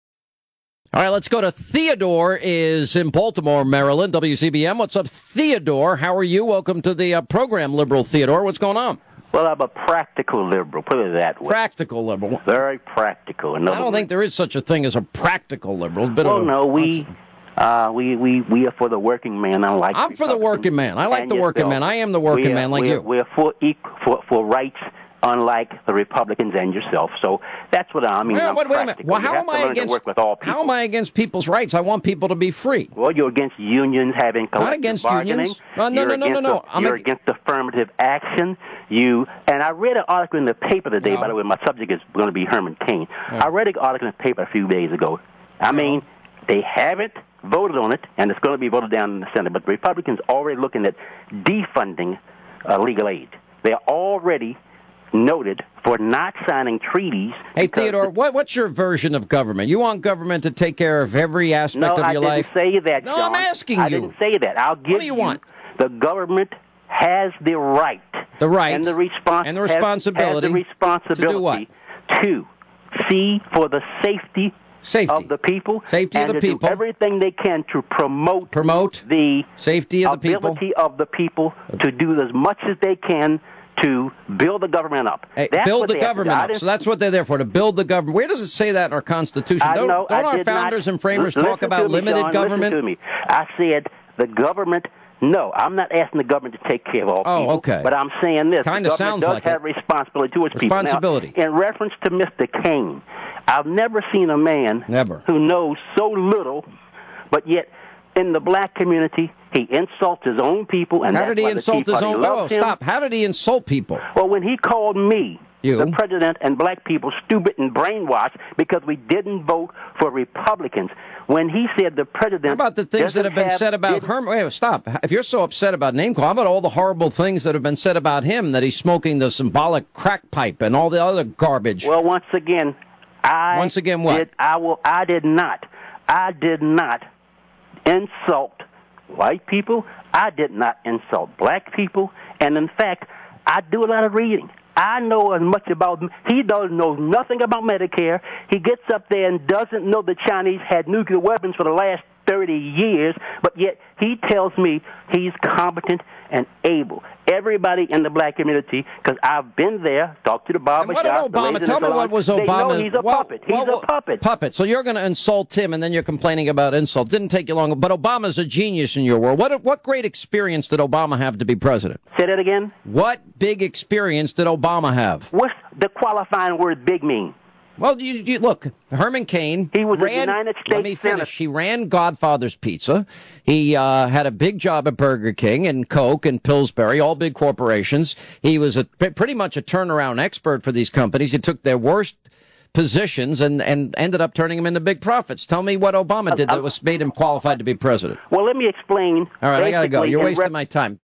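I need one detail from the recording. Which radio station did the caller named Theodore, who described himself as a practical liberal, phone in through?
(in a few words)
WCBM.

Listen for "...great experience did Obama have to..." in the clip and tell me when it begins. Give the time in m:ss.
2:49.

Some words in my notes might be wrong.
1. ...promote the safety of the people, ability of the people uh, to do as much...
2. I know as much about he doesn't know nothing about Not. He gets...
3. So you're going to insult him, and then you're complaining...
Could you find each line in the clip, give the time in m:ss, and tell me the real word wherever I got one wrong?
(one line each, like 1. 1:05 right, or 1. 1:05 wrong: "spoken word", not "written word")
1. 1:18 right
2. 2:24 wrong: "Medicare", not "Not"
3. 2:44 right.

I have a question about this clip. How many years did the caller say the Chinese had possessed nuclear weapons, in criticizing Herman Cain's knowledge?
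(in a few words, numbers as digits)
30.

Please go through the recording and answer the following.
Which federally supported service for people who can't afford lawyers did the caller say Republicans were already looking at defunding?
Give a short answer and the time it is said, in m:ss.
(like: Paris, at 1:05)
Legal aid, at 0:52.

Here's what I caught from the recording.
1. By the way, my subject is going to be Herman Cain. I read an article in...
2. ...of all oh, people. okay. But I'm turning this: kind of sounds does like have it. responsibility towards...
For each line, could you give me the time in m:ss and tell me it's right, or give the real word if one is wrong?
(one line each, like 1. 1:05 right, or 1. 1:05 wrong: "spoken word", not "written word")
1. 0:41 right
2. 1:37 wrong: "saying", not "turning".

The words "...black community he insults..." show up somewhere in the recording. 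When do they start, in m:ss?
1:48.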